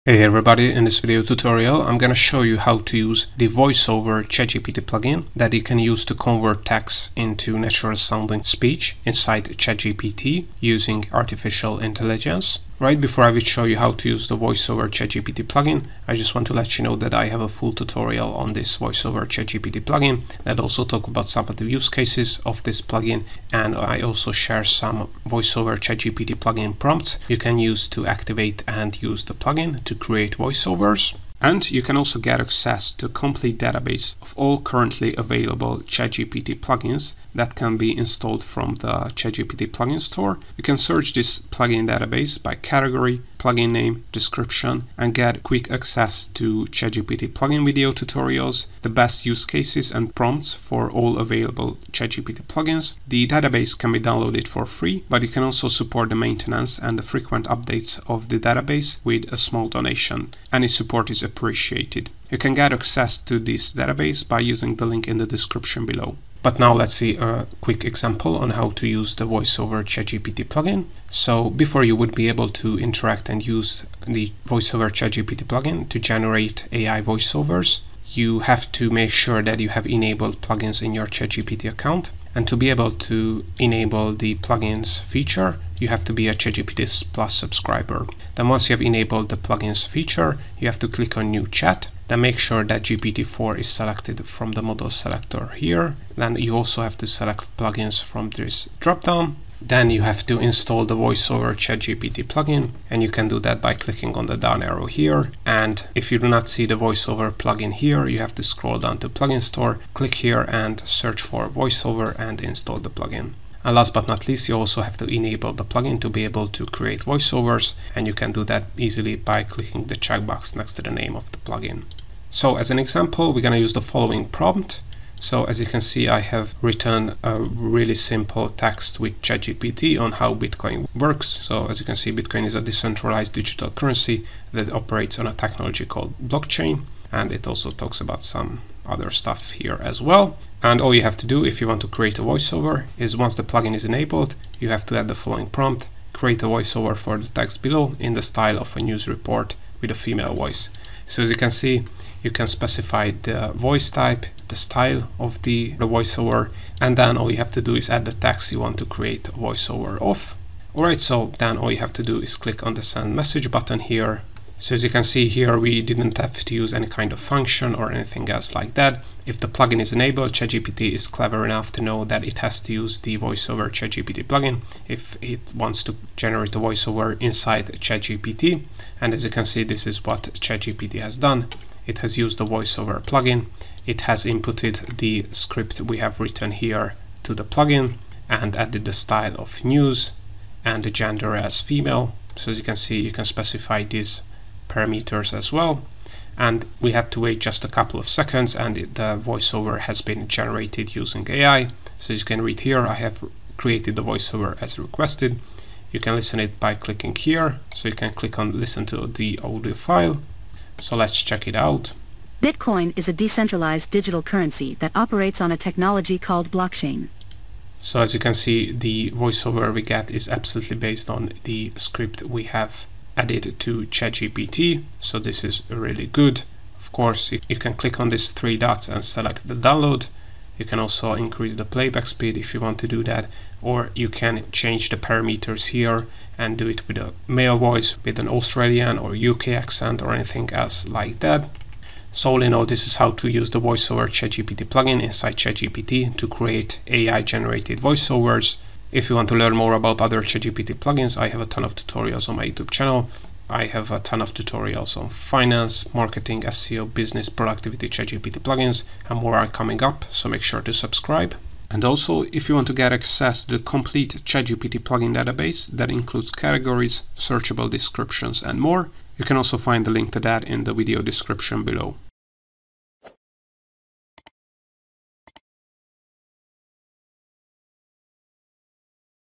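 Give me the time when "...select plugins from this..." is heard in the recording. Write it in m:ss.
1:37.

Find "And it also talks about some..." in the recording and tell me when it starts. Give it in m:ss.
2:17.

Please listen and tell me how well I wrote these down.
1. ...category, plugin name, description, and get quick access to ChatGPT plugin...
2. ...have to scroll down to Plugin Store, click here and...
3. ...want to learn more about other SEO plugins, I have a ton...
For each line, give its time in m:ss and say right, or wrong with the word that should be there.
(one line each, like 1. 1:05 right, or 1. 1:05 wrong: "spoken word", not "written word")
1. 0:42 right
2. 1:48 right
3. 4:09 wrong: "ChatGPT", not "SEO".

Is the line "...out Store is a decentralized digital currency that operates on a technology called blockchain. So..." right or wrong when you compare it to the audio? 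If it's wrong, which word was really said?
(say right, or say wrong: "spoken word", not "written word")
wrong: "Bitcoin", not "Store".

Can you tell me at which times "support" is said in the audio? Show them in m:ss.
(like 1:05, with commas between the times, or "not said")
0:55, 1:00.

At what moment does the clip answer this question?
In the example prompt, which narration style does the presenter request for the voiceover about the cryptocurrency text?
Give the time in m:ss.
2:28.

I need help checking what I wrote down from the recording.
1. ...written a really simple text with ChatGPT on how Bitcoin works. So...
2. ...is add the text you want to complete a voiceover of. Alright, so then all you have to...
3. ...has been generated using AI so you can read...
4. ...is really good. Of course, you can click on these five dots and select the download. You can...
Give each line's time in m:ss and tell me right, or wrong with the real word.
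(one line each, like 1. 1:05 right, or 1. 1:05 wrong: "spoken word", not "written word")
1. 2:06 right
2. 2:37 wrong: "create", not "complete"
3. 3:19 right
4. 3:45 wrong: "three", not "five".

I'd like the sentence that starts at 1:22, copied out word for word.
And to be able to enable the plugins feature, you have to be a ChatGPT Plus subscriber.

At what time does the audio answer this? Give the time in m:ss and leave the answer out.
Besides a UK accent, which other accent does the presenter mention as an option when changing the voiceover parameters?
3:58.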